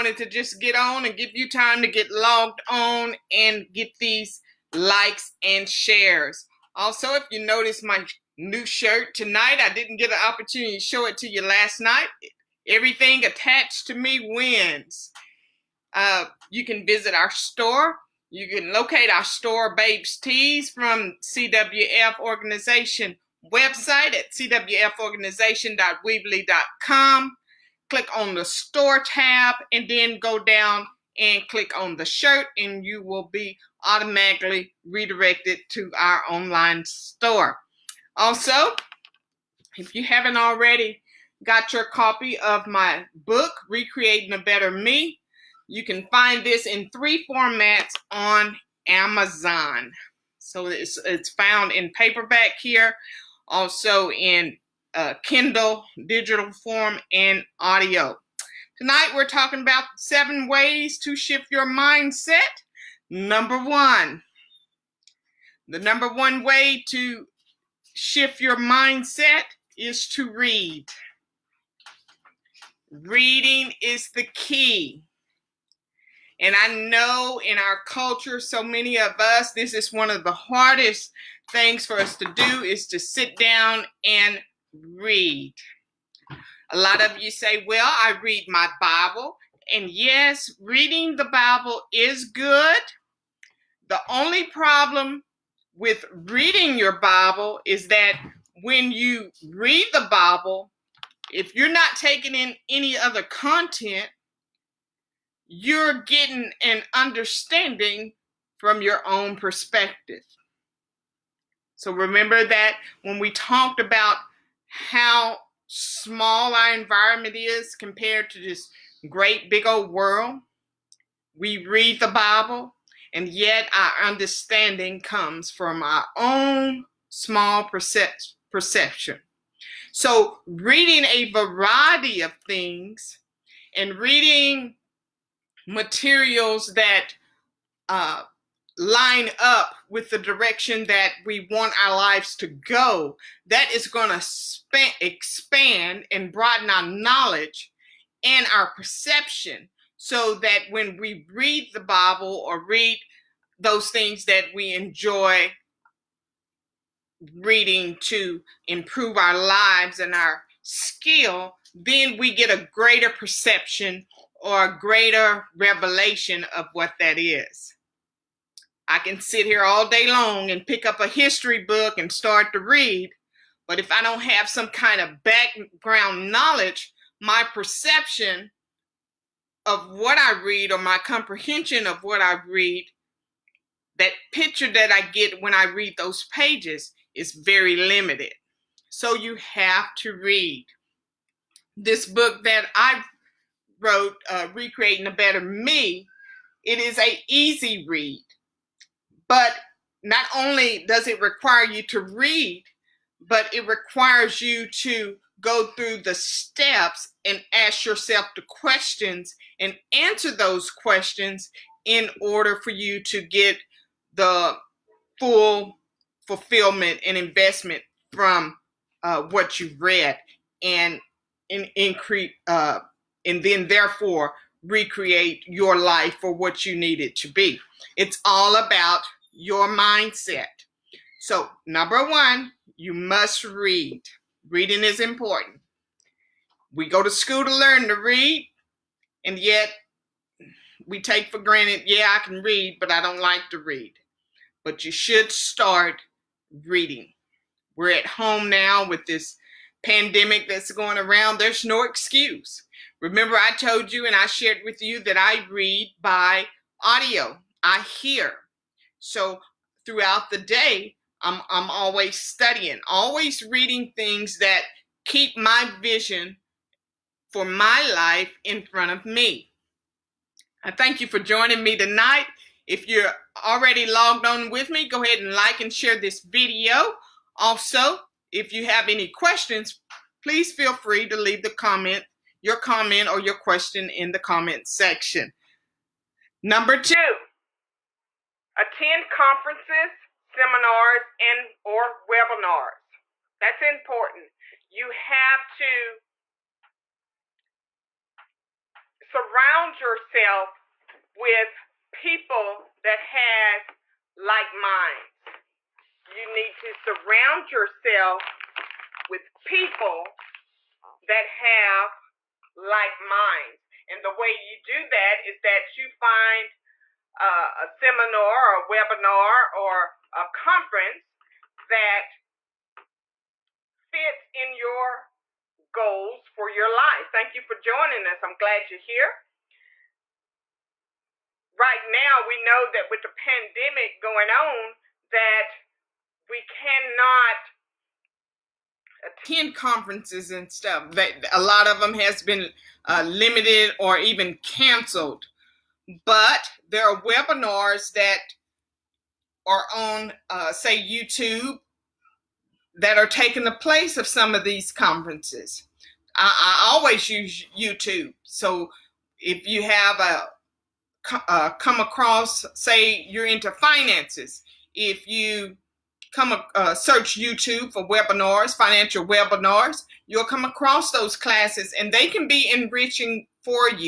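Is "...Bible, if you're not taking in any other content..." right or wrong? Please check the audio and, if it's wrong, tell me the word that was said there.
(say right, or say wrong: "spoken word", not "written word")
right.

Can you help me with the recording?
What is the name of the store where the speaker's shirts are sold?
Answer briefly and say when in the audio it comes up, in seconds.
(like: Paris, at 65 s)
Babes Tees, at 19 s.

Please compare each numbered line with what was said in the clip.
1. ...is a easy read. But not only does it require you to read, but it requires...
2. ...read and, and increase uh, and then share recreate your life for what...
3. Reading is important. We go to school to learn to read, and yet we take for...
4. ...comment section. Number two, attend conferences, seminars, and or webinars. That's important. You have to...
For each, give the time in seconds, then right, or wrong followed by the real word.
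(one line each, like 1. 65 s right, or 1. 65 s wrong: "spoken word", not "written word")
1. 196 s right
2. 219 s wrong: "therefore", not "share"
3. 234 s right
4. 284 s right.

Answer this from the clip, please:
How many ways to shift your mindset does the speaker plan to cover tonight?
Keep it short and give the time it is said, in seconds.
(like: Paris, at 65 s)
7, at 59 s.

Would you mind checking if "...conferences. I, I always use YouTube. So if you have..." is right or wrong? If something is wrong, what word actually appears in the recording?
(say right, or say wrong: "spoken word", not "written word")
right.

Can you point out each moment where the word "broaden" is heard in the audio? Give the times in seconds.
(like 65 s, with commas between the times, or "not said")
146 s.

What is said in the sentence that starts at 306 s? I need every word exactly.
You need to surround yourself with people that have like minds.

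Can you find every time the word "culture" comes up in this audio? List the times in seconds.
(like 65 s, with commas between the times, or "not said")
77 s.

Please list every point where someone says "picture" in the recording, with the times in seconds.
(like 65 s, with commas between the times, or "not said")
184 s.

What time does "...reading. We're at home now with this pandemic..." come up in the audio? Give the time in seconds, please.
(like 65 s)
246 s.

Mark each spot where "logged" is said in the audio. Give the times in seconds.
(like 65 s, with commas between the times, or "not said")
2 s, 273 s.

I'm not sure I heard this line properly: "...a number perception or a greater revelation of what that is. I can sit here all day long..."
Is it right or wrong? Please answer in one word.
wrong.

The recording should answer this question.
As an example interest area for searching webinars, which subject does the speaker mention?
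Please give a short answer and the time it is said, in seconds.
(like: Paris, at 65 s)
finances, at 363 s.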